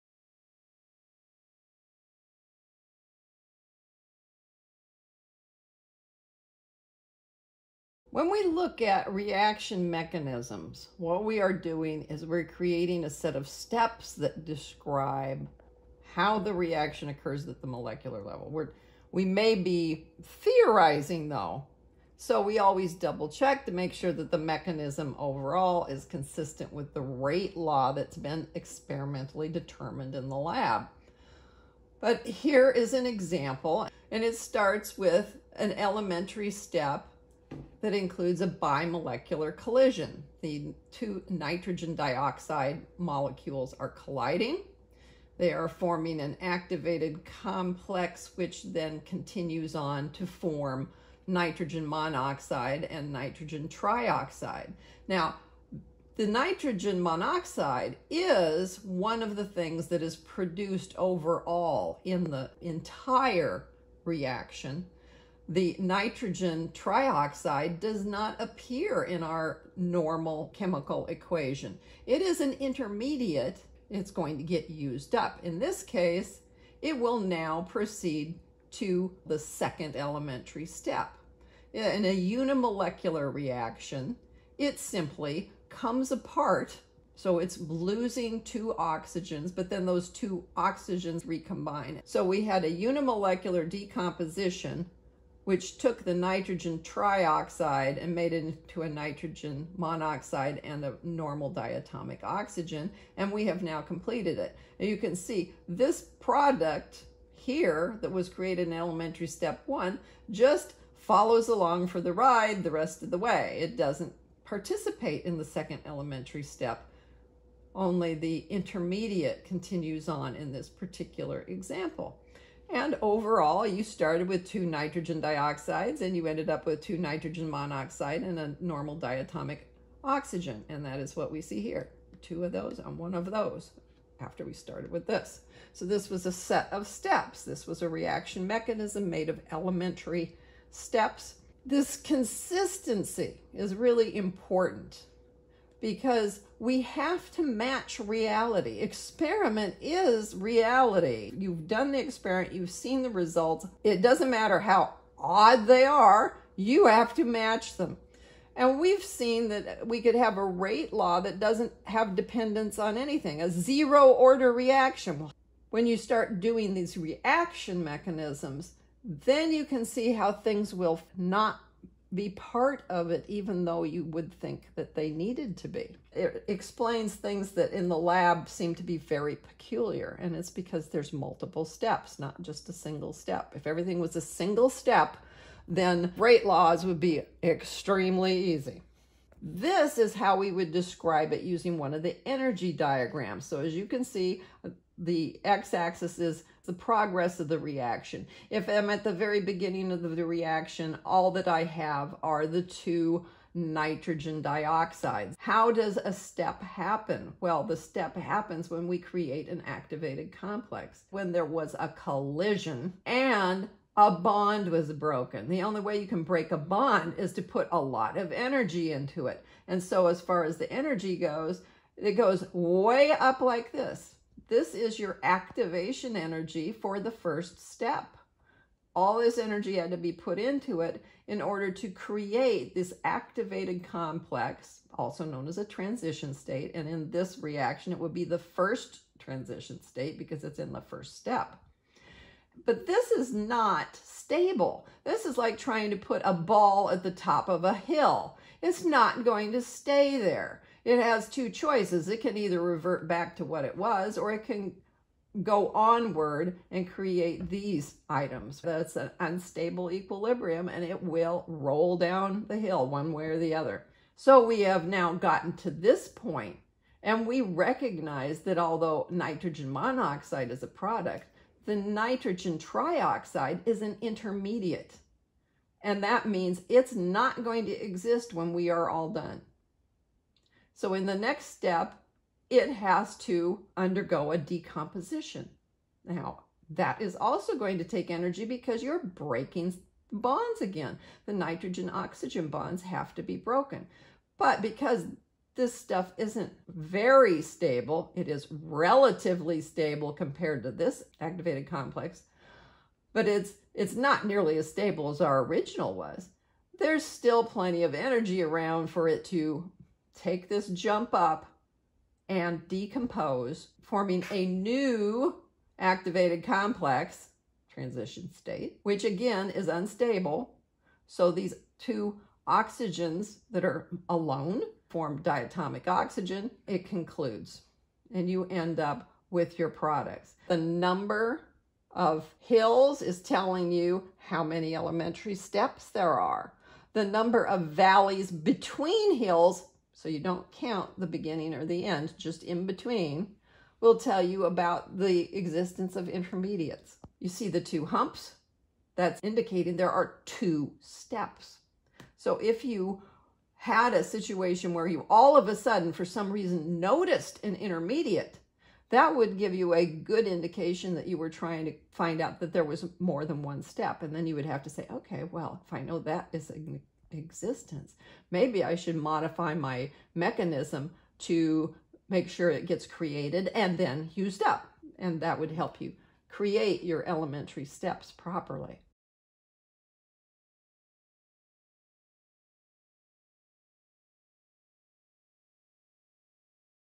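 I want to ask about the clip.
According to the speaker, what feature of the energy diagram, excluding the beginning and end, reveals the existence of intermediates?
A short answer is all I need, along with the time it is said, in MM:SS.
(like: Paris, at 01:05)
valleys between hills, at 05:37.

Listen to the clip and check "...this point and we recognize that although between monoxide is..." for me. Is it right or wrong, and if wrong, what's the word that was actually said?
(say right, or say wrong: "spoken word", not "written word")
wrong: "nitrogen", not "between".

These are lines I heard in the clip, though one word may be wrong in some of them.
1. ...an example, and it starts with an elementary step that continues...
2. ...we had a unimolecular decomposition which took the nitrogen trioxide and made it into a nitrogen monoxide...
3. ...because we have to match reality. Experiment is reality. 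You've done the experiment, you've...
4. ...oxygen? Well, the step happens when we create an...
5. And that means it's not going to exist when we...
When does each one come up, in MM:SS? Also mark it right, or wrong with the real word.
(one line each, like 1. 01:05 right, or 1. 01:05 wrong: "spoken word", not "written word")
1. 00:32 wrong: "includes", not "continues"
2. 01:32 right
3. 02:25 right
4. 03:26 wrong: "happen", not "oxygen"
5. 04:35 right.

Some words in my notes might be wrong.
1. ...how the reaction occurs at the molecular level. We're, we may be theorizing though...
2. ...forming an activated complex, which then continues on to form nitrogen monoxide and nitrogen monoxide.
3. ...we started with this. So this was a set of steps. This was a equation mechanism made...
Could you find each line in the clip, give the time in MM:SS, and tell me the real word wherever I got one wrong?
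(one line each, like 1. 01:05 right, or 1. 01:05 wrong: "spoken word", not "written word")
1. 00:16 right
2. 00:45 wrong: "trioxide", not "monoxide"
3. 02:14 wrong: "reaction", not "equation".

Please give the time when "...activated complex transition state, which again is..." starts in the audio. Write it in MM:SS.
05:15.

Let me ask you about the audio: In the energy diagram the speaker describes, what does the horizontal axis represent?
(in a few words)
progress of the reaction.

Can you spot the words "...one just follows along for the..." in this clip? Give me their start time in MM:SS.
01:49.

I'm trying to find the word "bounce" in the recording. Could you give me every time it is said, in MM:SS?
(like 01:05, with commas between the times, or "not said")
not said.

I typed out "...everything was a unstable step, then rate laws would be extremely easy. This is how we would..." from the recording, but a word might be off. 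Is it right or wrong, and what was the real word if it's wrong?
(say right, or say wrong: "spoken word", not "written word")
wrong: "single", not "unstable".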